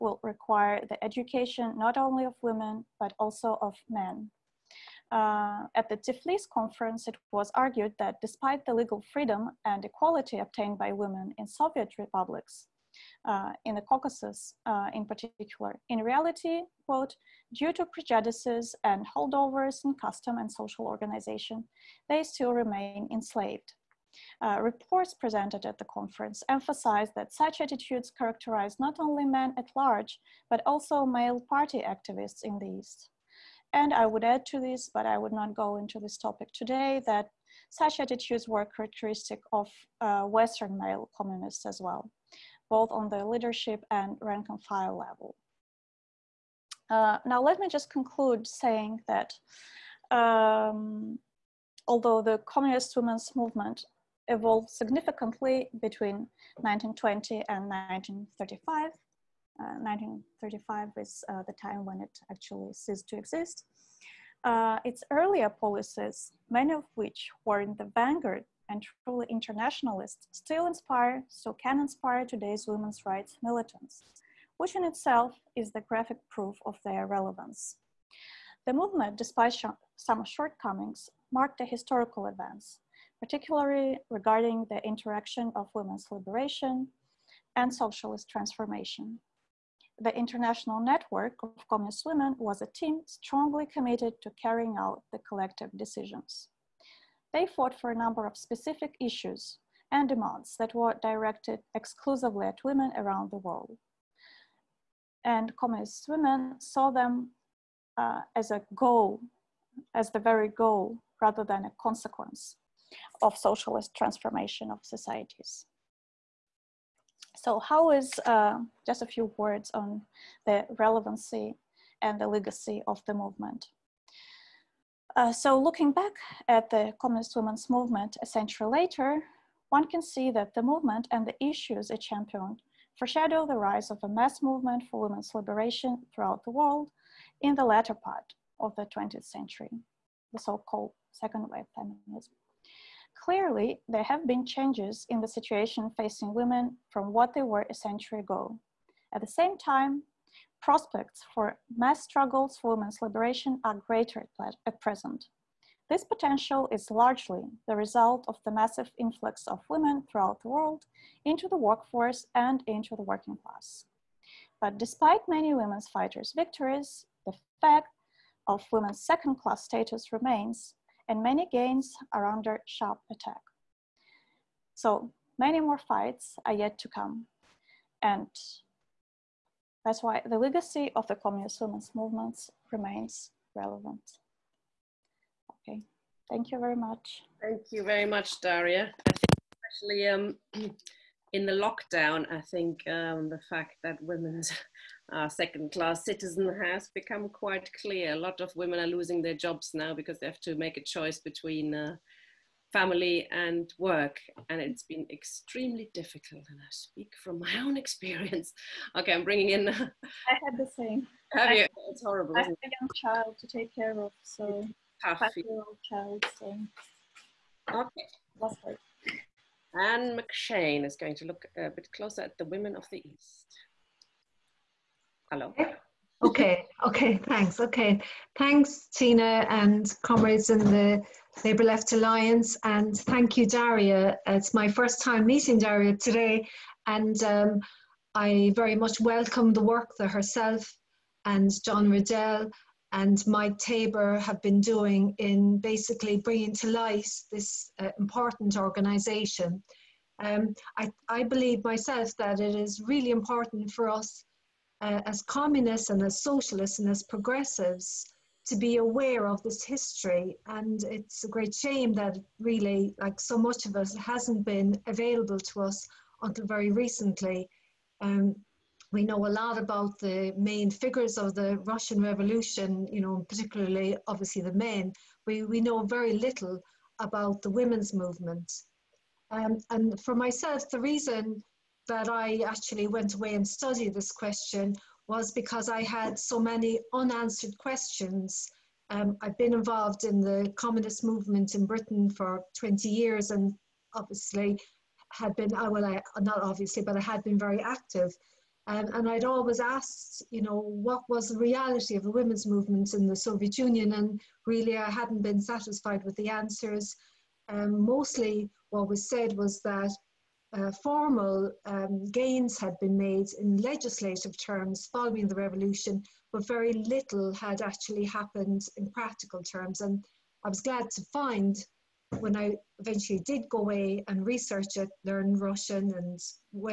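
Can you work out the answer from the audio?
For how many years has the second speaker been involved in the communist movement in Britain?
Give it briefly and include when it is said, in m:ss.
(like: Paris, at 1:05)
20, at 4:52.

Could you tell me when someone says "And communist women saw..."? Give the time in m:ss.
1:45.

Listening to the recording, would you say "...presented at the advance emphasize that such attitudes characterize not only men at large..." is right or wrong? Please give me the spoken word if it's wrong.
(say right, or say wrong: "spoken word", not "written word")
wrong: "conference", not "advance".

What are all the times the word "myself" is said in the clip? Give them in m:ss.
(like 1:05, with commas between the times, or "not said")
4:11, 4:40.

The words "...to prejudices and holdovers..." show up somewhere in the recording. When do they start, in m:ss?
0:17.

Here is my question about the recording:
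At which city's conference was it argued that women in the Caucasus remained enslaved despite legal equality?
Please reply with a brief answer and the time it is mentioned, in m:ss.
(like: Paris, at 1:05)
Tiflis, at 0:05.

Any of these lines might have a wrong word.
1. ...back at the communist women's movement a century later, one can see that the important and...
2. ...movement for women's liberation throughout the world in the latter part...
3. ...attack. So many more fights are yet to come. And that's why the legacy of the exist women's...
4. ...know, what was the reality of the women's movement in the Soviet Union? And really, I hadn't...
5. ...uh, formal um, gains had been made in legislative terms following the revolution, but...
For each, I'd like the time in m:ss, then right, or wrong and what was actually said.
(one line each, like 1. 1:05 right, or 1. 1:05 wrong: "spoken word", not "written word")
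1. 2:05 wrong: "movement", not "important"
2. 2:14 right
3. 2:53 wrong: "communist", not "exist"
4. 5:00 right
5. 5:10 right.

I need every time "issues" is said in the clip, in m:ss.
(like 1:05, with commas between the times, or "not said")
1:39, 2:11.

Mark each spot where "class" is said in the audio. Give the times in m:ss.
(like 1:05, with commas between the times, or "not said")
2:43, 2:49, 3:15.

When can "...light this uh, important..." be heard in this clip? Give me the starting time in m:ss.
4:06.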